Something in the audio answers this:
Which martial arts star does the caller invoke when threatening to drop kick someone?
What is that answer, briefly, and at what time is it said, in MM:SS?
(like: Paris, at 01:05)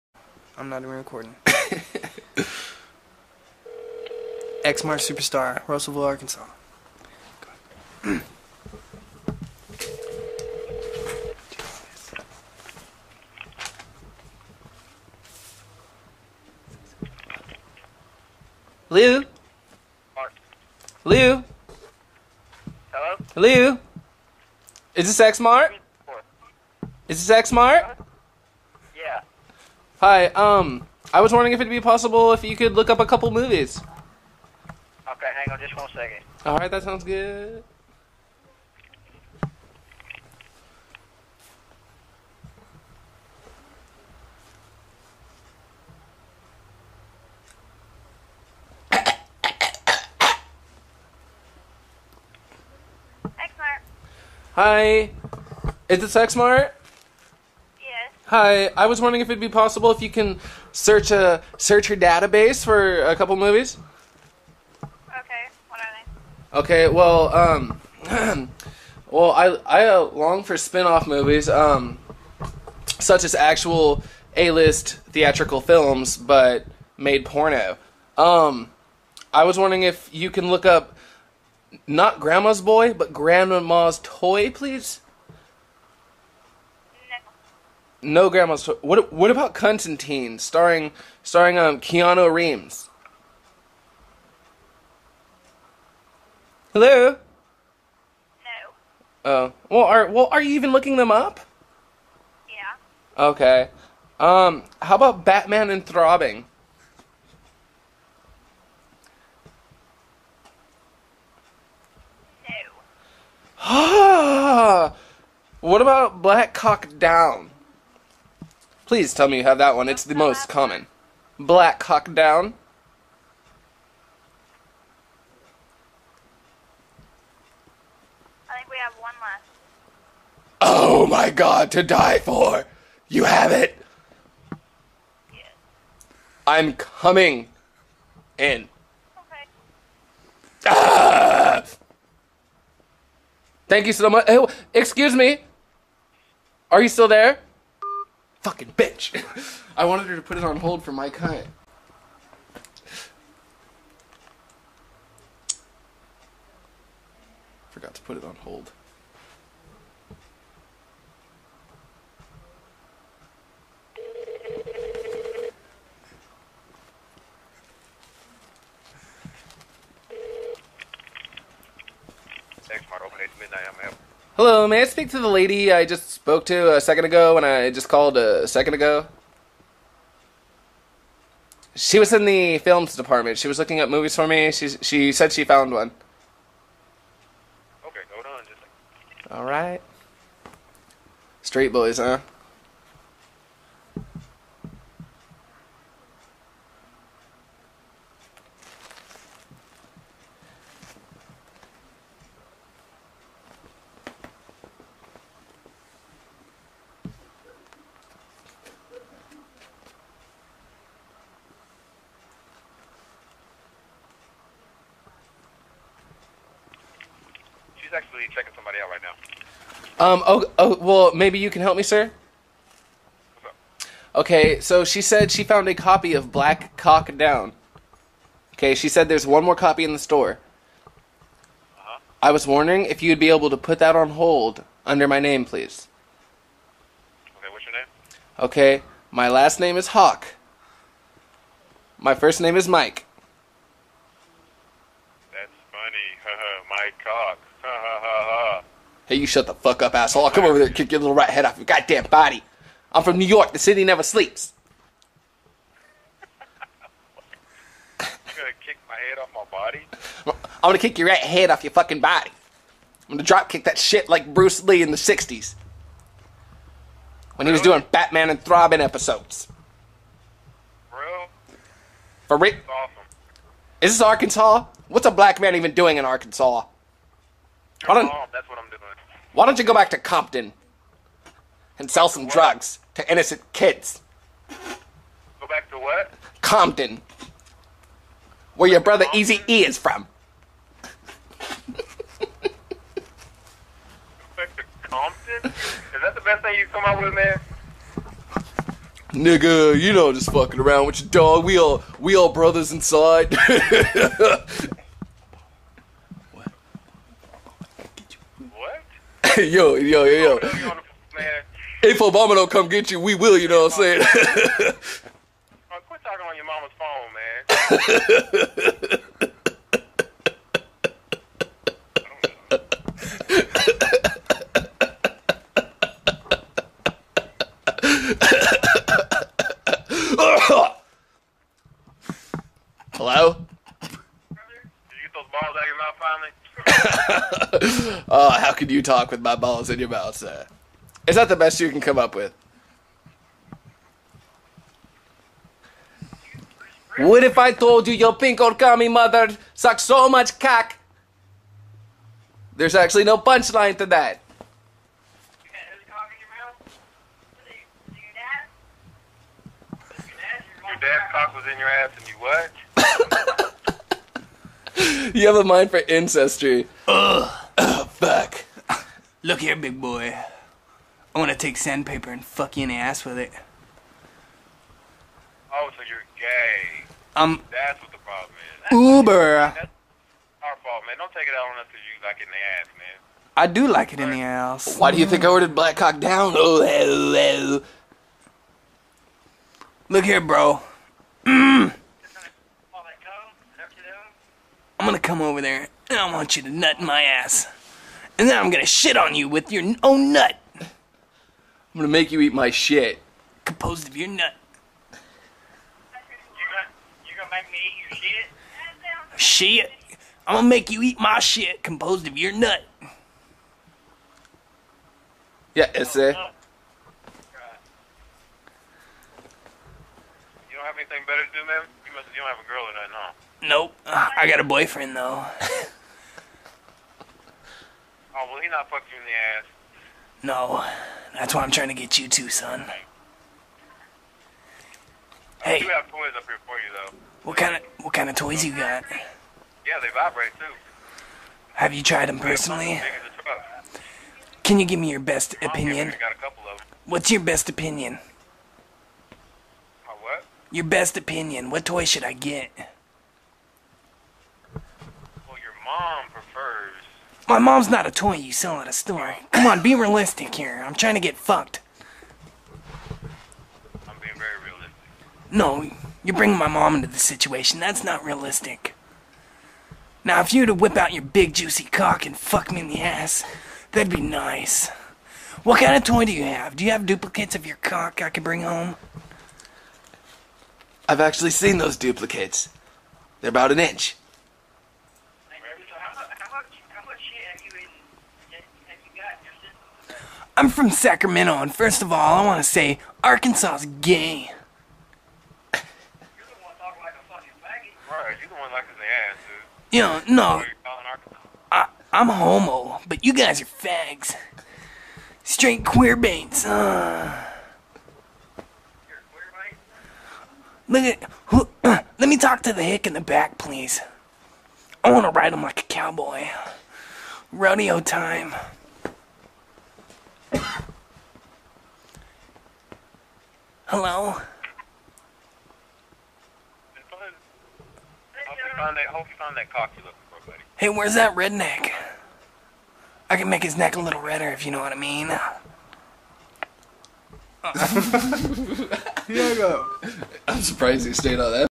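Bruce Lee, at 04:24.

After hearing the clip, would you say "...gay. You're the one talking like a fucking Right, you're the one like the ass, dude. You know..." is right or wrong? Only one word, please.
right.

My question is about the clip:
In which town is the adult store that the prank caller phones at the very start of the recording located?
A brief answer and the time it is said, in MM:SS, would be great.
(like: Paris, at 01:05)
Russellville, at 00:05.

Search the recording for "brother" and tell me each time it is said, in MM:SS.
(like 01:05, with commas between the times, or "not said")
04:48, 05:02.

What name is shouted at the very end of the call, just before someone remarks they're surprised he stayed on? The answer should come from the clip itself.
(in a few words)
Diego.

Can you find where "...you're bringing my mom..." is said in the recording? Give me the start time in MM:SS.
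07:46.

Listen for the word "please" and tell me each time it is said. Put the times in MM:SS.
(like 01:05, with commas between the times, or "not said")
01:24, 01:58, 03:55, 08:33.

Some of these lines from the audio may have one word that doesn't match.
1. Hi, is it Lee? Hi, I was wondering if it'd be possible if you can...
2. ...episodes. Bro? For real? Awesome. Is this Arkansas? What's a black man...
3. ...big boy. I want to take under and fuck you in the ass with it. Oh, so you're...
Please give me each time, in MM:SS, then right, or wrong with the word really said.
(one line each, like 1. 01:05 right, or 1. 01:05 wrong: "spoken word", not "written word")
1. 00:54 wrong: "Sexmart", not "Lee"
2. 04:28 right
3. 06:09 wrong: "sandpaper", not "under".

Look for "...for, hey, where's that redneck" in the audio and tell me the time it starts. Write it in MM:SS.
08:49.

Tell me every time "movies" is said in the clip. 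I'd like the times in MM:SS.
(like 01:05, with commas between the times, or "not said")
00:33, 01:03, 01:11, 03:03.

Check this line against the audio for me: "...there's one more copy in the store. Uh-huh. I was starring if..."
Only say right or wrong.
wrong.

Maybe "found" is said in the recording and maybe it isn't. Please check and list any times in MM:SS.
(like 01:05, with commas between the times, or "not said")
03:05, 03:45.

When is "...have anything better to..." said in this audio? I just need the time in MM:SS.
07:00.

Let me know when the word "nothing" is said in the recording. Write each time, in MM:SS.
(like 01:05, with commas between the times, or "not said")
07:02.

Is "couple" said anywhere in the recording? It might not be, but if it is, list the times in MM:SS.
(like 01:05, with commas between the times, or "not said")
00:33, 01:03.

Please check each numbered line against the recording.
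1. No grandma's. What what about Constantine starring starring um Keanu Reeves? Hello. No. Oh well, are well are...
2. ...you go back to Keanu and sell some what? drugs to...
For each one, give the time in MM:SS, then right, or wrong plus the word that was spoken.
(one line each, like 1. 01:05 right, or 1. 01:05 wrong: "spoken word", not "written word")
1. 01:28 right
2. 04:39 wrong: "Compton", not "Keanu".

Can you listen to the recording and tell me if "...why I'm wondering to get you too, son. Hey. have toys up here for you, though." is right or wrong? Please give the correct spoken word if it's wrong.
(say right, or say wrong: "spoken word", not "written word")
wrong: "trying", not "wondering".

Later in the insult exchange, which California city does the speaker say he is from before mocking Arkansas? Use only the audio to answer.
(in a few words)
Sacramento.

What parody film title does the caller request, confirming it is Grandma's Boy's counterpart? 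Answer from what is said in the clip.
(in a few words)
Grandma's Toy.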